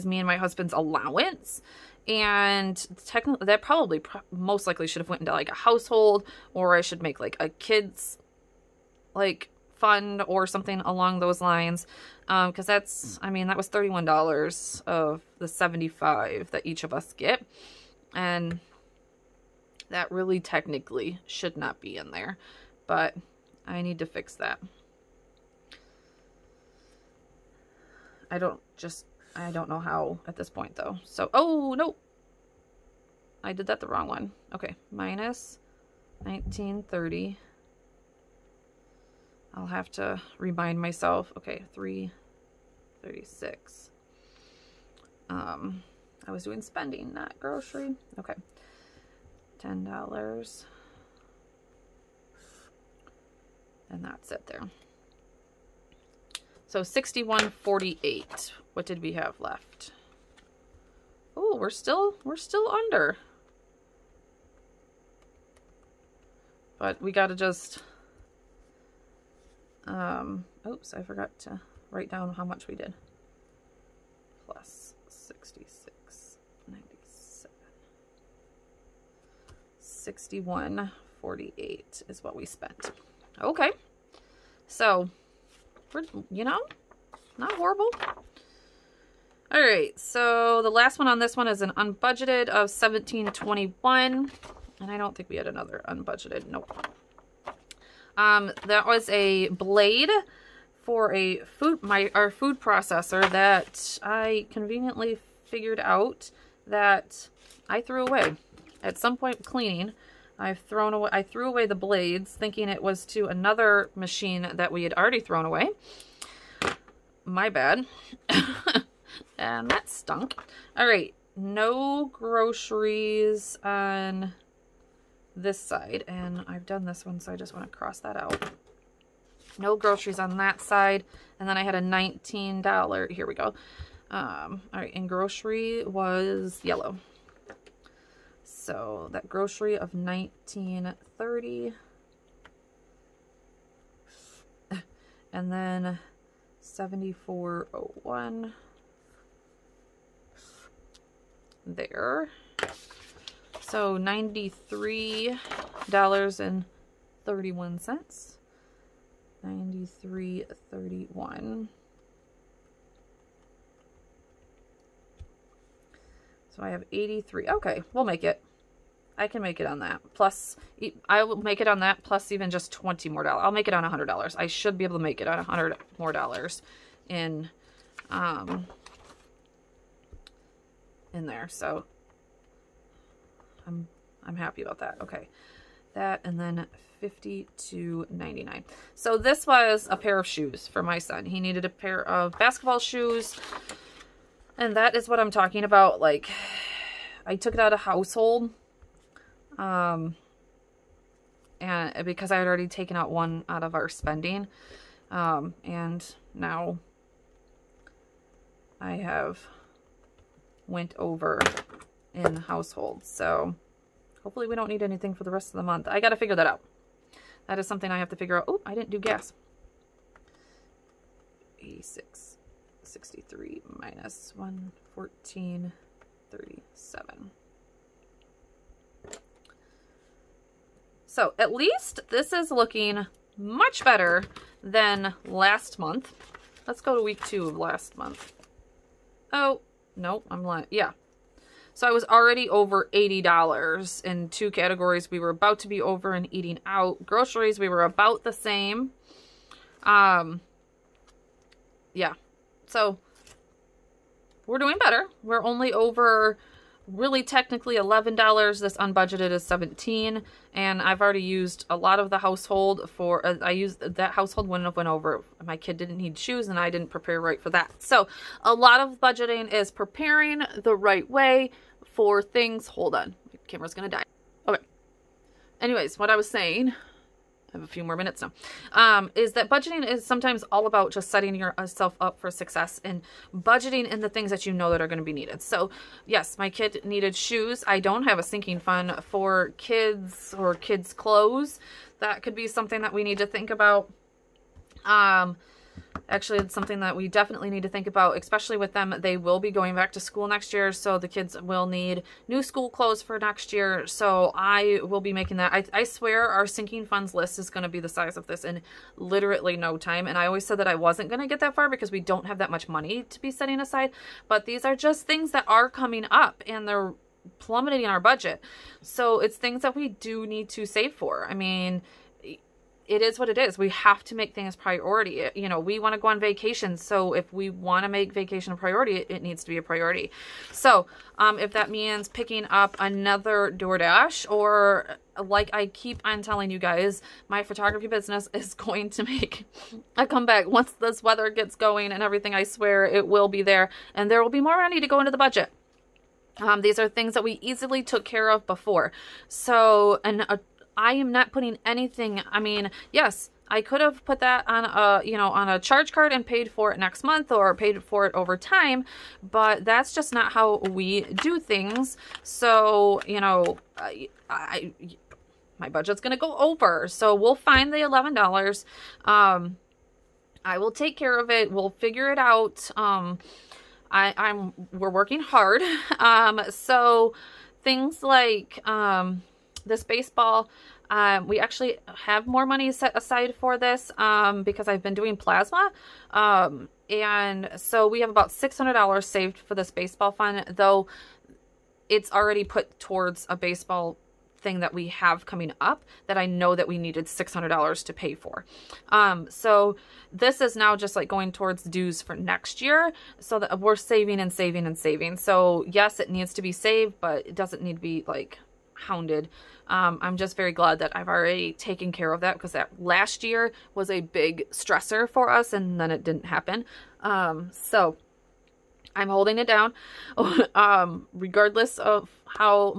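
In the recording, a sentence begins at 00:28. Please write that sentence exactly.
I don't just, I don't know how at this point though.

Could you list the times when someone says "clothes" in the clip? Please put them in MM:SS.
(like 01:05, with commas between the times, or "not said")
04:50, 05:02.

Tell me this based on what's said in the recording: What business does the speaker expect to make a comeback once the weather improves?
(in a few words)
Photography business.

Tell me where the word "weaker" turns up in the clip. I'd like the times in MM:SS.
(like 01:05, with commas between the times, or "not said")
not said.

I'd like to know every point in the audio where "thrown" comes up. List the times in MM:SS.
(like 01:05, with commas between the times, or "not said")
01:50, 01:55.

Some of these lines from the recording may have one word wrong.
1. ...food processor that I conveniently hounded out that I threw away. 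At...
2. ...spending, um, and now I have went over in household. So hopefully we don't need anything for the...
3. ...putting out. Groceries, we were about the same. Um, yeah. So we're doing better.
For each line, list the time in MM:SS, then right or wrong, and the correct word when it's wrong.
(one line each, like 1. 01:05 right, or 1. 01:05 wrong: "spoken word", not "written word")
1. 01:42 wrong: "figured", not "hounded"
2. 03:23 right
3. 04:06 wrong: "eating", not "putting".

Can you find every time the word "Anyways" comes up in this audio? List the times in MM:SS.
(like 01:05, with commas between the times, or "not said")
04:35.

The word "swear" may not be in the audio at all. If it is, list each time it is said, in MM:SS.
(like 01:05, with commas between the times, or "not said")
05:05, 05:42.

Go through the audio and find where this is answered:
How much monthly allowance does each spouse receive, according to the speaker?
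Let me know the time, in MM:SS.
00:15.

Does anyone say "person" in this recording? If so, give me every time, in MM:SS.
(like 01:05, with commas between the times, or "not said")
not said.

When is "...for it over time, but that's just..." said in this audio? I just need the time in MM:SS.
05:57.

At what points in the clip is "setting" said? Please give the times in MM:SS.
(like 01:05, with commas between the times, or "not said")
04:41, 05:13.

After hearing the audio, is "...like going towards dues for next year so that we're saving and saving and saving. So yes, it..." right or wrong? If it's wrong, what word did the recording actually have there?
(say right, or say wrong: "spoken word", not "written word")
right.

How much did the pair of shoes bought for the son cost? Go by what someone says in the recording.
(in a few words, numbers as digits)
$52.99.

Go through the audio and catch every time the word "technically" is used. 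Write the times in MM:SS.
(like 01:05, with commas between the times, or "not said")
00:03, 00:20, 04:17.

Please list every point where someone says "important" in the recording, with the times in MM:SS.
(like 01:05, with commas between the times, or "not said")
not said.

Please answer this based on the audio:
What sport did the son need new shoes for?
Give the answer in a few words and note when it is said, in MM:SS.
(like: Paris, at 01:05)
Basketball, at 03:12.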